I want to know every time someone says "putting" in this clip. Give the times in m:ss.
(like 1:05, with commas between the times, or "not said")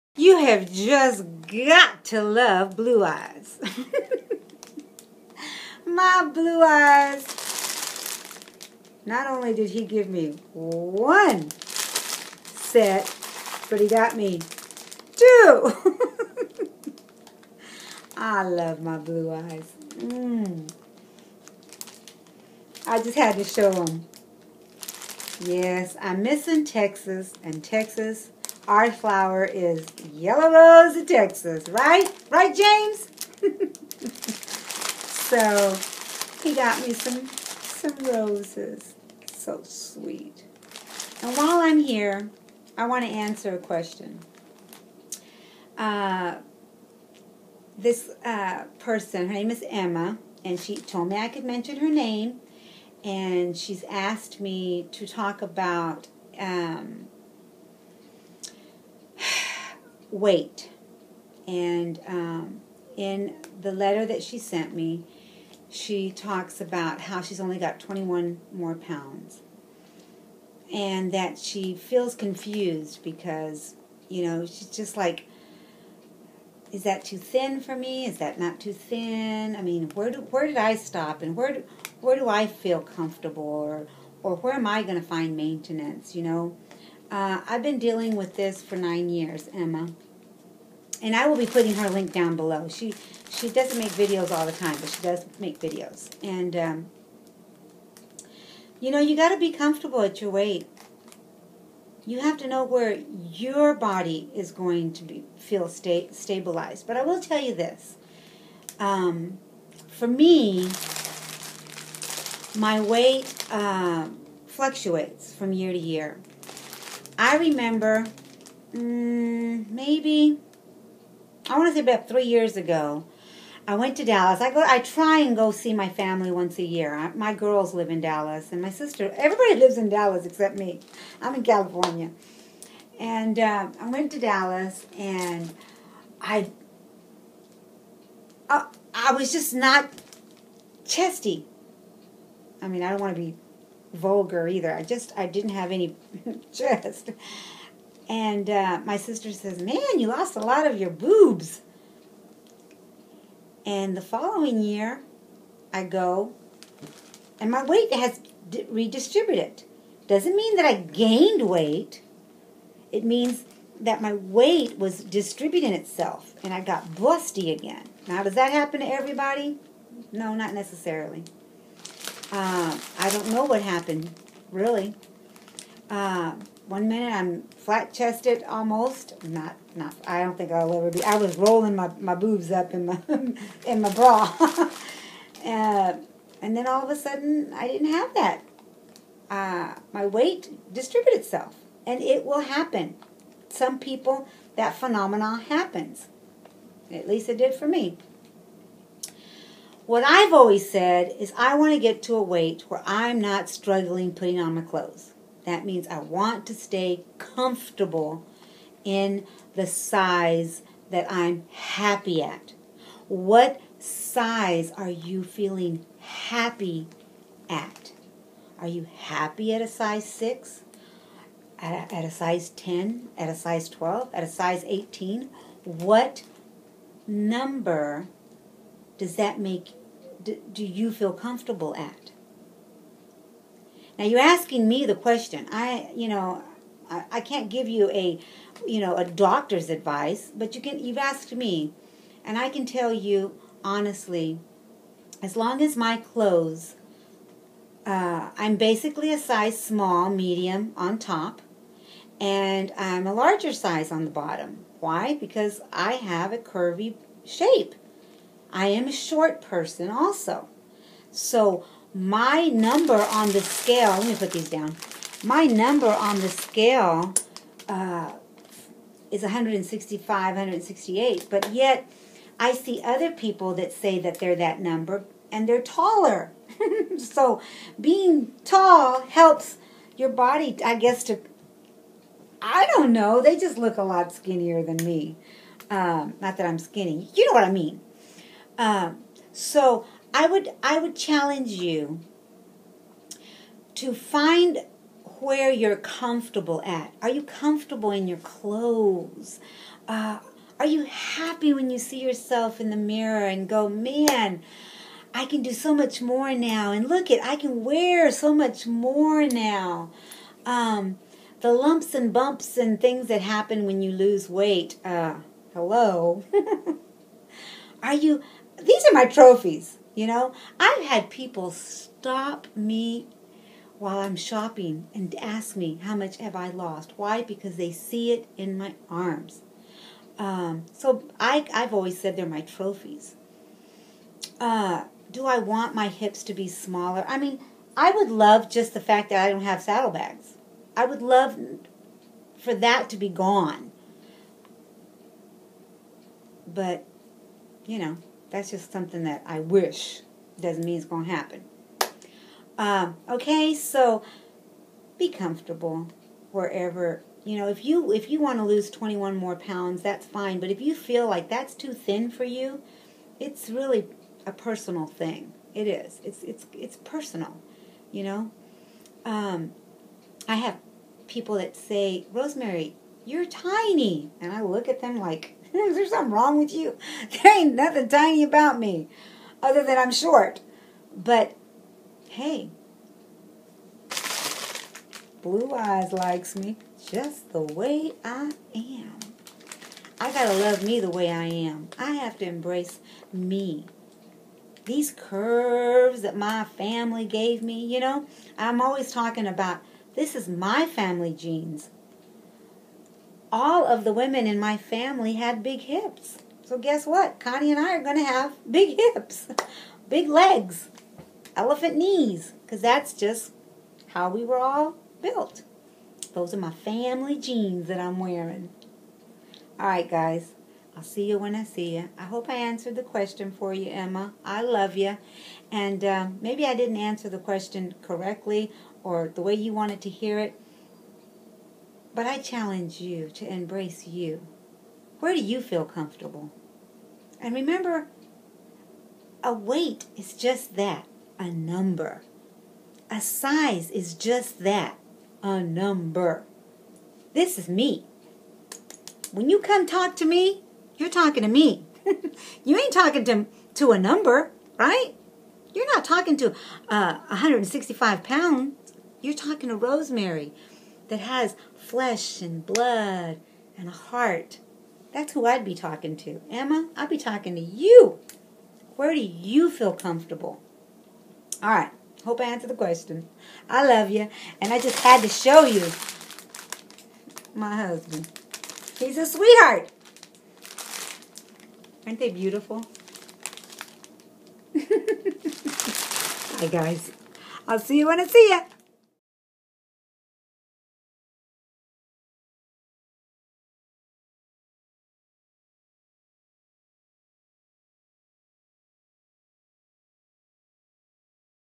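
1:31, 3:24.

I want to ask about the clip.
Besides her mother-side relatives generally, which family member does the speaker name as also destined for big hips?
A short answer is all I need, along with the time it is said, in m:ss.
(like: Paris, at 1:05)
Connie, at 6:47.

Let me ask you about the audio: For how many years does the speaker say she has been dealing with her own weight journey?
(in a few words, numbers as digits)
9.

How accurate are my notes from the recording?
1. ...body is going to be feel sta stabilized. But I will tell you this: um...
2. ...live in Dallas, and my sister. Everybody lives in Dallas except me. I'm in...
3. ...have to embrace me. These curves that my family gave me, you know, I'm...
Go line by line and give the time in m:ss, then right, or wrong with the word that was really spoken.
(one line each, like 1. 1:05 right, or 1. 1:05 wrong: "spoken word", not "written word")
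1. 1:43 right
2. 2:07 right
3. 6:31 right.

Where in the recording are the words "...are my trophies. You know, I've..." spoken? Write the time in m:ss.
5:18.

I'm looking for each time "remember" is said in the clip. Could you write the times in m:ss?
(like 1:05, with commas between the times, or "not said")
1:57, 7:17.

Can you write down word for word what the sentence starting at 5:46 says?
But, you know, that's just something that I wish.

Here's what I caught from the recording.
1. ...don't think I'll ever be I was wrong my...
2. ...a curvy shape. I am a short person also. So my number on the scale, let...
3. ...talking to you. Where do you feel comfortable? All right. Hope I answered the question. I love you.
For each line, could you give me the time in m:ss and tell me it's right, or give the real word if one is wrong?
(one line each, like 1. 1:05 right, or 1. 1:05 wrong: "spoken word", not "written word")
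1. 3:00 wrong: "rolling", not "wrong"
2. 4:16 right
3. 7:46 right.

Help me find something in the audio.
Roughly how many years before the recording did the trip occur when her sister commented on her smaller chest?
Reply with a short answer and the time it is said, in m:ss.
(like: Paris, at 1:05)
3, at 2:02.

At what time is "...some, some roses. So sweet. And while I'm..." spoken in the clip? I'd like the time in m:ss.
0:36.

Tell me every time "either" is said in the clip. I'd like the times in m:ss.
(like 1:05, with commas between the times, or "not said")
2:24.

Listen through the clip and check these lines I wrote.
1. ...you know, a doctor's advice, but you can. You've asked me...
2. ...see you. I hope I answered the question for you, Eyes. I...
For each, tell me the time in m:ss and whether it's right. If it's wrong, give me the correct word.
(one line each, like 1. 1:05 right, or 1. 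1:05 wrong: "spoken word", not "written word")
1. 3:58 right
2. 7:01 wrong: "Emma", not "Eyes".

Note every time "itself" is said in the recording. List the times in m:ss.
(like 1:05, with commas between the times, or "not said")
2:45, 3:11.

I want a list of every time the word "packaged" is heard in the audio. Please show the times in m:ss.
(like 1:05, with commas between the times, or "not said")
not said.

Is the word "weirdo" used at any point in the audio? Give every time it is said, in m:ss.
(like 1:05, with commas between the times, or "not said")
not said.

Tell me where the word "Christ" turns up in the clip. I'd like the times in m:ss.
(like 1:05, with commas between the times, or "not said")
not said.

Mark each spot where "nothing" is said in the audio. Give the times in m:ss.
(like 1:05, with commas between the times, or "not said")
6:17.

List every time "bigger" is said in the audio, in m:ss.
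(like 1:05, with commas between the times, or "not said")
not said.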